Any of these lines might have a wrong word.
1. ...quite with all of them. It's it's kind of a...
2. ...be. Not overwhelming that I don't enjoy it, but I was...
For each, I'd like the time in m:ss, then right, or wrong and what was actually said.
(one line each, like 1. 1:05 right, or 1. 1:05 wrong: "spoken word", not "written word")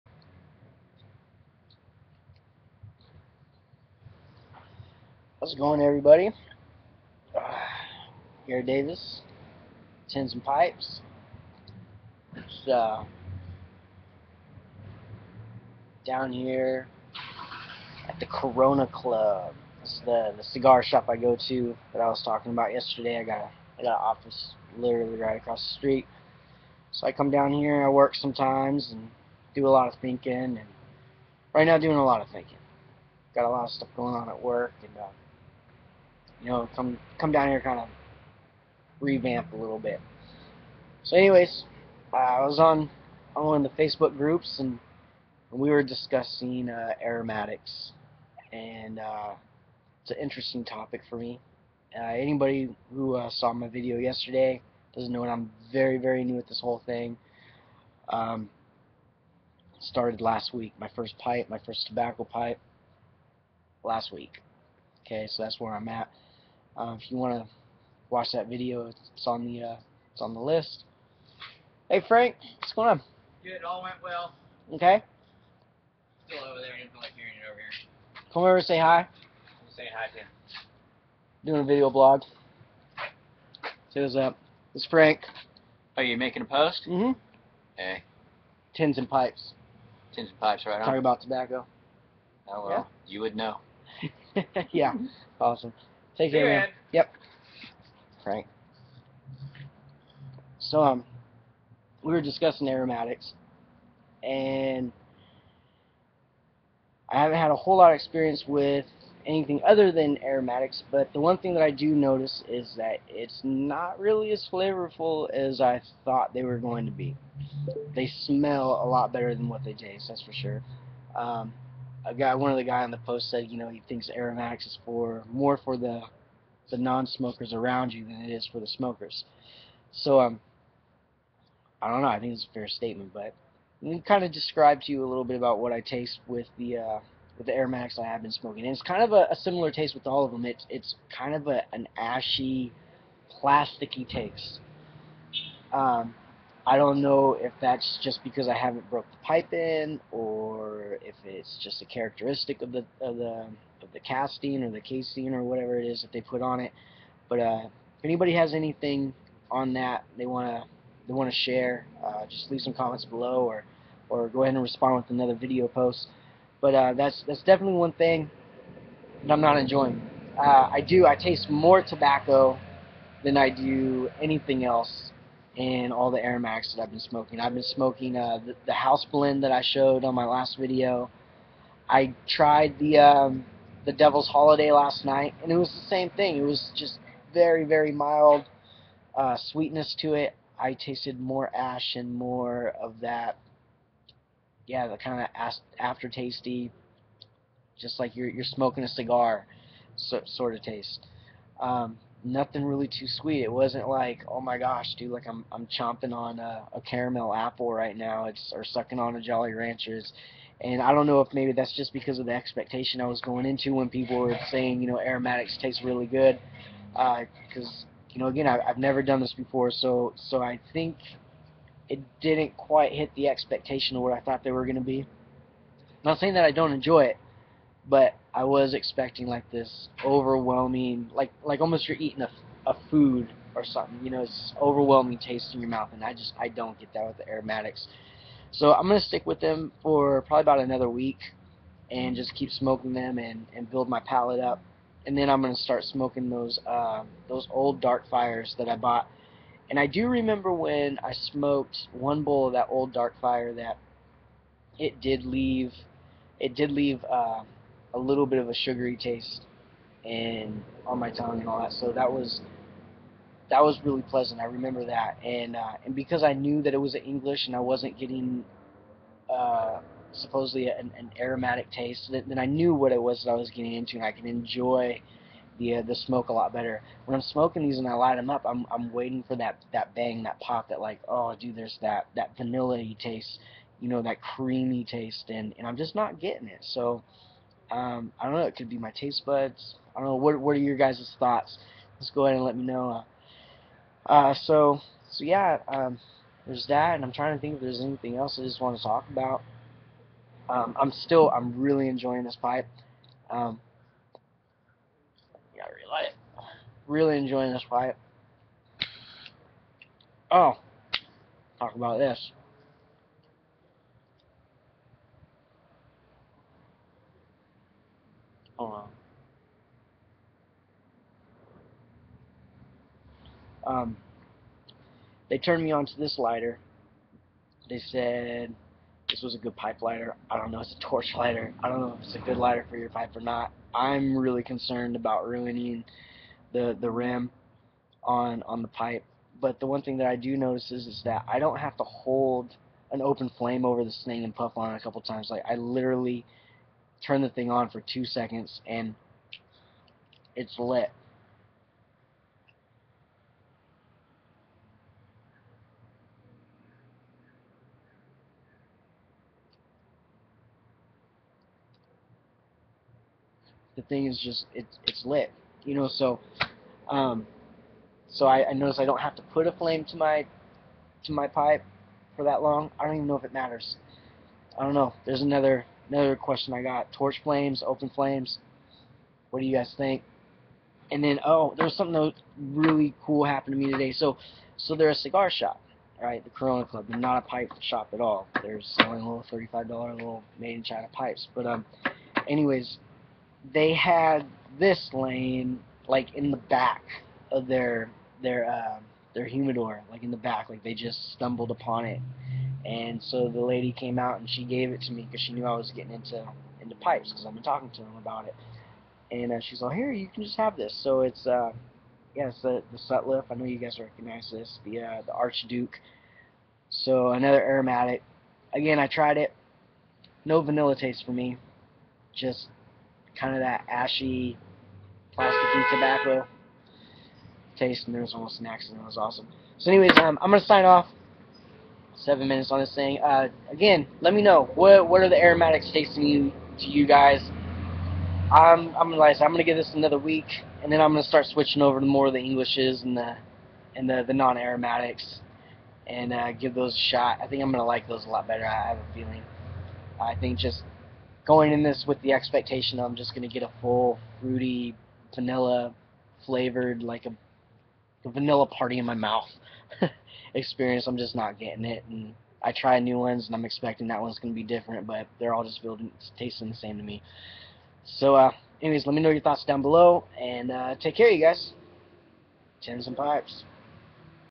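1. 2:19 wrong: "taste", not "quite"
2. 3:44 wrong: "saying", not "overwhelming".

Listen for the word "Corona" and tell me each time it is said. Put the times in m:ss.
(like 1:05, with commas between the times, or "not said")
0:18, 6:26.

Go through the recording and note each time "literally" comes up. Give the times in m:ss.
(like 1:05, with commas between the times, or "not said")
0:24, 5:45.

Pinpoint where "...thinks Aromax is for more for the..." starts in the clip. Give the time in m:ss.
2:03.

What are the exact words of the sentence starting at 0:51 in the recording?
Uh, anybody who uh, saw my video yesterday doesn't know that I'm very very new at this whole thing.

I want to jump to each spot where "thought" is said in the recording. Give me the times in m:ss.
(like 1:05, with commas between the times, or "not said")
1:56, 3:44, 4:51, 7:49.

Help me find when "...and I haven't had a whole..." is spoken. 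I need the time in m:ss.
1:44.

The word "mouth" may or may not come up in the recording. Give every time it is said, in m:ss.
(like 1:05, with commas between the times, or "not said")
3:55, 7:38.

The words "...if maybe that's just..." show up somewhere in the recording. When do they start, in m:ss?
3:31.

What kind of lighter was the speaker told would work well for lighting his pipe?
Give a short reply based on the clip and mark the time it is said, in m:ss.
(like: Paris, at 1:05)
Torch lighter, at 5:30.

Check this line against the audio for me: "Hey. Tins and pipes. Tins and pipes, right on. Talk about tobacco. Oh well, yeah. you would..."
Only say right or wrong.
right.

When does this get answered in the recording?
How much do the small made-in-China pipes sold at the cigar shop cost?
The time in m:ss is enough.
6:29.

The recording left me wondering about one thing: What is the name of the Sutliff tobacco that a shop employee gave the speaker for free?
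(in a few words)
Archduke.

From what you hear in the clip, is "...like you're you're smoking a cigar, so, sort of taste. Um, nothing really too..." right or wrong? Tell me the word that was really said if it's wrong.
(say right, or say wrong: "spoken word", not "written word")
right.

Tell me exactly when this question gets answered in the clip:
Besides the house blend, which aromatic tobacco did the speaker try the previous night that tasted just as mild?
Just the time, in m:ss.
3:03.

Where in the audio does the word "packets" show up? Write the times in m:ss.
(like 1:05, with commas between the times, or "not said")
not said.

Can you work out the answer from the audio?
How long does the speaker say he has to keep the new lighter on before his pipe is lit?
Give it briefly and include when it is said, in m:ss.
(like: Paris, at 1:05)
2 seconds, at 5:47.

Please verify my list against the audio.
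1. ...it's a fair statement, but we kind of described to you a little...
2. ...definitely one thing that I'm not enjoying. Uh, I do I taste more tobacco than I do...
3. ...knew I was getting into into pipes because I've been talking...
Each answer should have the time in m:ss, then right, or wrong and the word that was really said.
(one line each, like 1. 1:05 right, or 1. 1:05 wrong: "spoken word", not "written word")
1. 2:12 right
2. 2:47 right
3. 6:45 right.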